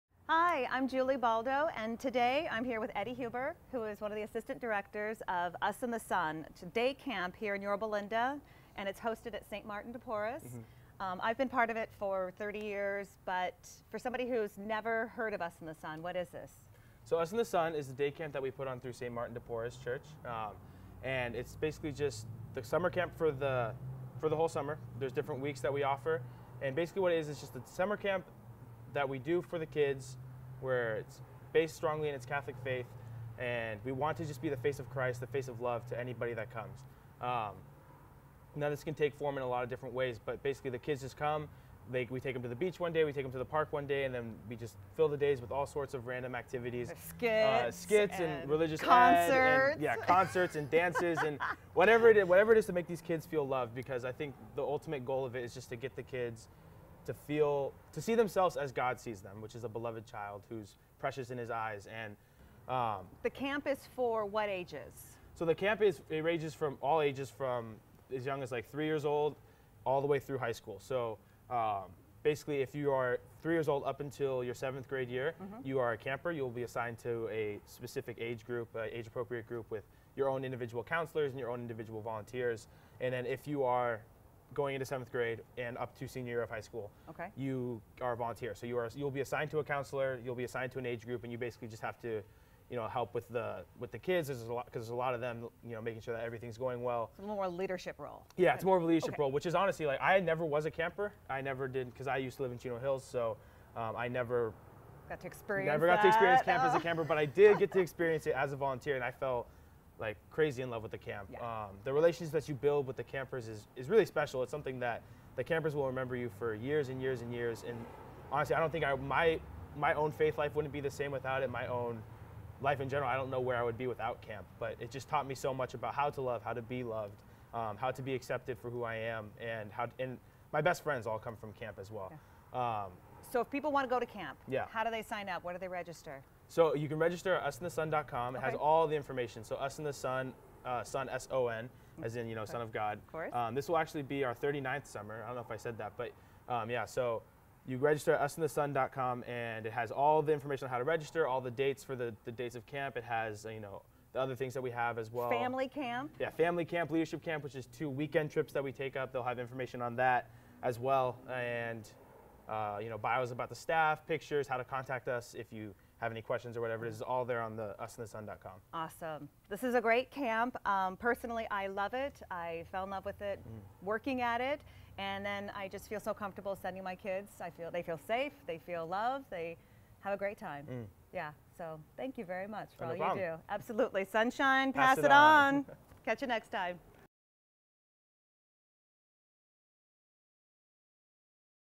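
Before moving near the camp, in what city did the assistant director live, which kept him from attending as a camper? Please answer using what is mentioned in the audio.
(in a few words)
Chino Hills.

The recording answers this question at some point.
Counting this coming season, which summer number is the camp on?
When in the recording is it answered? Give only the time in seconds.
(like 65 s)
144 s.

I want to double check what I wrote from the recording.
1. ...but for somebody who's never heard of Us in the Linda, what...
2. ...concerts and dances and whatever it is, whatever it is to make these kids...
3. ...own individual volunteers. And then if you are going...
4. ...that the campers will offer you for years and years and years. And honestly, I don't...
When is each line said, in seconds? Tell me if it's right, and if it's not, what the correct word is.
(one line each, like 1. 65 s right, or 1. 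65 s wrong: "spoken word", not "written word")
1. 13 s wrong: "Son", not "Linda"
2. 49 s right
3. 81 s right
4. 114 s wrong: "remember", not "offer".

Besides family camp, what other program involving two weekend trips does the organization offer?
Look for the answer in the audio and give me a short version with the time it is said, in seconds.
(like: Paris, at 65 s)
Leadership camp, at 156 s.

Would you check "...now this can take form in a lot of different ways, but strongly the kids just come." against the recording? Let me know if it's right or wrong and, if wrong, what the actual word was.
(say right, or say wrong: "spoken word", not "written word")
wrong: "basically", not "strongly".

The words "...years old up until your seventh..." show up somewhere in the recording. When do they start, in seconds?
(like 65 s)
73 s.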